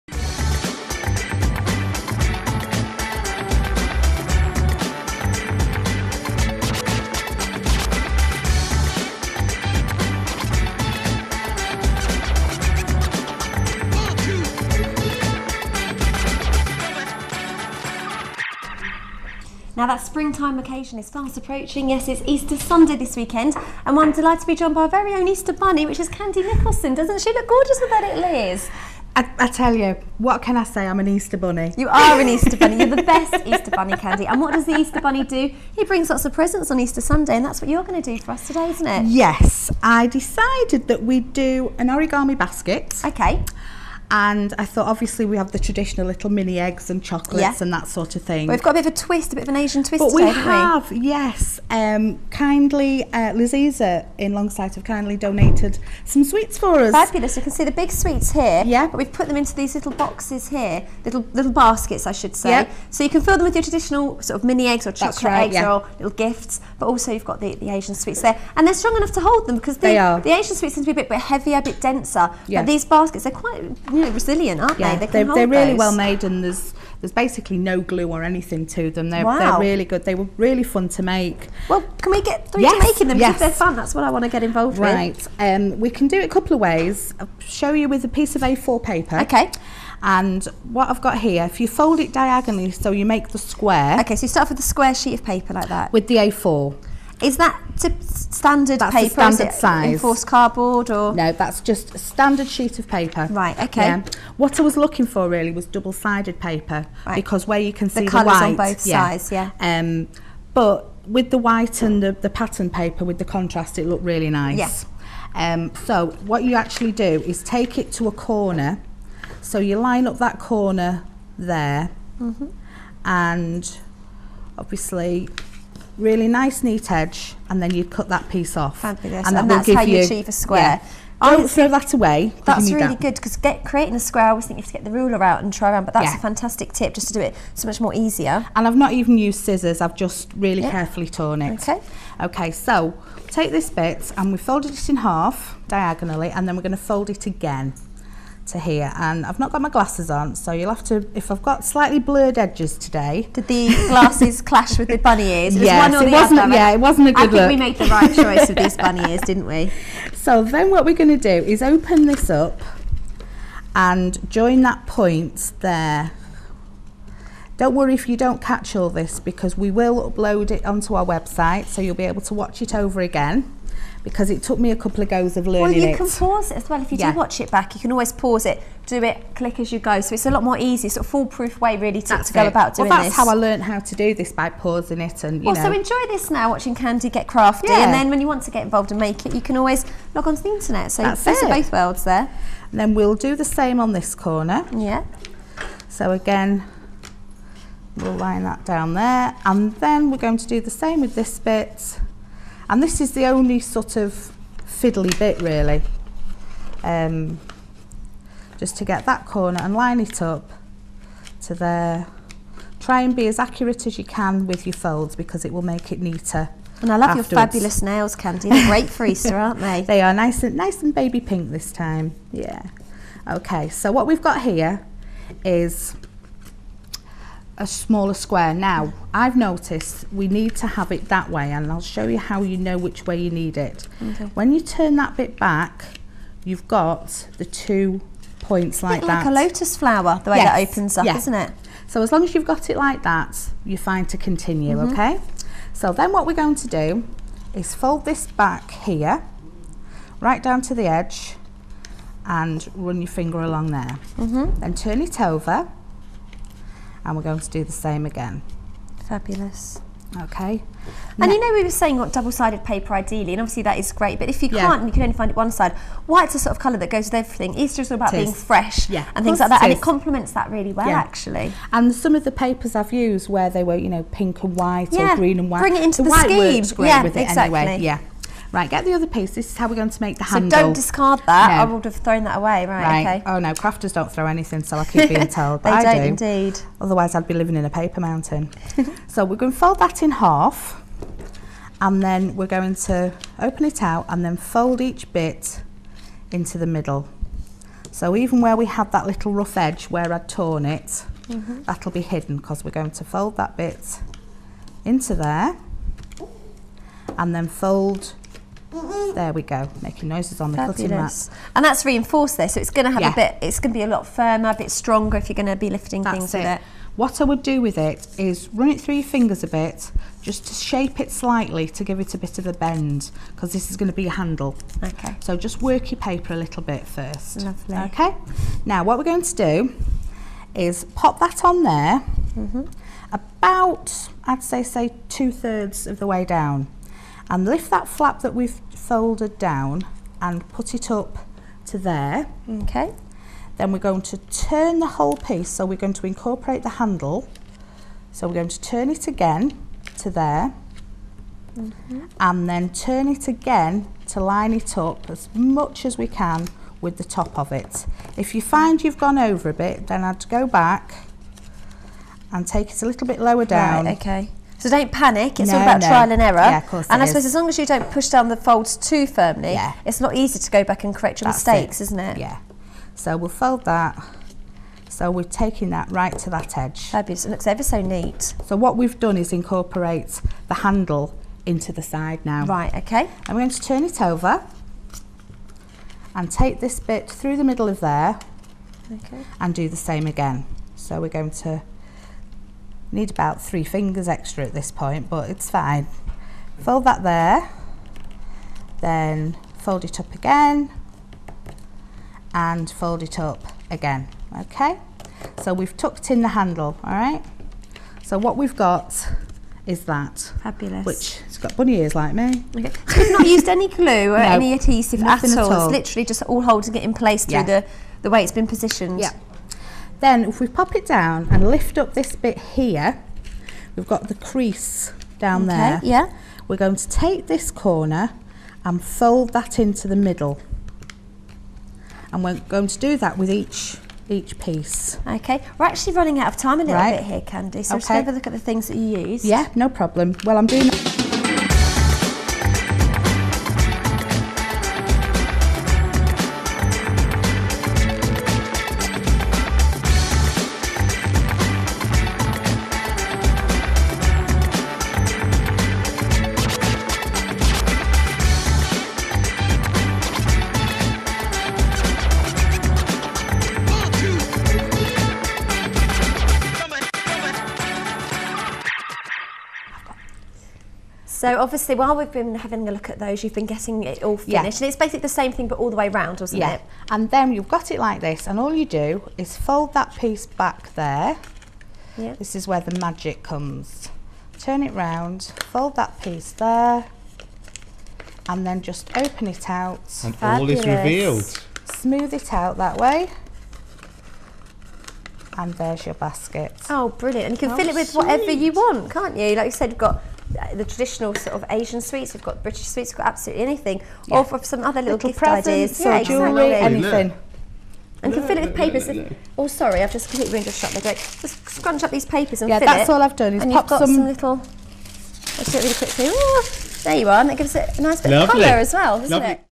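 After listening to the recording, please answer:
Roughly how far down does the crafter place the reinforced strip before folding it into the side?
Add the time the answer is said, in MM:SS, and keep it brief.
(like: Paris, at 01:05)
Two thirds, at 05:35.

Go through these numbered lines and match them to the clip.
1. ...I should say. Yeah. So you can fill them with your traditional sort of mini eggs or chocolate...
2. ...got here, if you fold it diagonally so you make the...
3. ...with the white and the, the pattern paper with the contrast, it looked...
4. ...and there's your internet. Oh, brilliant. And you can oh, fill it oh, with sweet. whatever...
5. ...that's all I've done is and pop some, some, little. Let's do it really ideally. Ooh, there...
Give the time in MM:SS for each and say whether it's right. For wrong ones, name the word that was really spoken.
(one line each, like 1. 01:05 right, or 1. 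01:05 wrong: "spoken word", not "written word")
1. 01:02 right
2. 01:31 right
3. 01:51 right
4. 08:15 wrong: "basket", not "internet"
5. 08:32 wrong: "quickly", not "ideally".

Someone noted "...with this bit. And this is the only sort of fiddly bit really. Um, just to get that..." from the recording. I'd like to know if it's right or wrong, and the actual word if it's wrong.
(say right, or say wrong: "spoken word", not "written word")
right.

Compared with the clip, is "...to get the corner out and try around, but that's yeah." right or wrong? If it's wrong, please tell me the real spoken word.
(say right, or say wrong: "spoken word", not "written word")
wrong: "ruler", not "corner".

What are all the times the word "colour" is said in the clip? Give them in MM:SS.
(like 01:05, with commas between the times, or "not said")
01:48, 04:26, 08:38.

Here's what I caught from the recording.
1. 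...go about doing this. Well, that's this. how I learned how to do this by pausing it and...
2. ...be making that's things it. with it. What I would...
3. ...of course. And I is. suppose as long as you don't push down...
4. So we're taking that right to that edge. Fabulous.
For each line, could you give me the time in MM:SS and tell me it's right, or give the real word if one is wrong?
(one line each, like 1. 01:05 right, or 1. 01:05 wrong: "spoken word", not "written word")
1. 03:02 right
2. 05:15 wrong: "lifting", not "making"
3. 06:06 right
4. 06:14 right.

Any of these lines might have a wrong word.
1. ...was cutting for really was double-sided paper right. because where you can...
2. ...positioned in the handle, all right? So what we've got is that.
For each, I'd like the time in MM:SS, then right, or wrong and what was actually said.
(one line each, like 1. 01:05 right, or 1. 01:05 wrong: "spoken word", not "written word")
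1. 01:44 wrong: "looking", not "cutting"
2. 06:45 wrong: "tucked", not "positioned".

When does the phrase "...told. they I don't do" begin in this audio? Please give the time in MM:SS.
04:45.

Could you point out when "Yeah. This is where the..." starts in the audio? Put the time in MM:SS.
08:01.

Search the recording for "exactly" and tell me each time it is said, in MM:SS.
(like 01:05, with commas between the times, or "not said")
04:37, 08:26.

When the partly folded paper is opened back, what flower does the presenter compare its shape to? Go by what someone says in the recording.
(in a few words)
Lotus flower.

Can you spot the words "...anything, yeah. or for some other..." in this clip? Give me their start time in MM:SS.
08:23.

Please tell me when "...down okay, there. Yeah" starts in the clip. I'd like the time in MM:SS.
07:05.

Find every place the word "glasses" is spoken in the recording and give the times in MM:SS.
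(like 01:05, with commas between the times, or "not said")
02:29, 02:33.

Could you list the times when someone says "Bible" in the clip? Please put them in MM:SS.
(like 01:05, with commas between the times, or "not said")
not said.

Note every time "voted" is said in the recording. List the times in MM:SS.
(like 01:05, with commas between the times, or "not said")
not said.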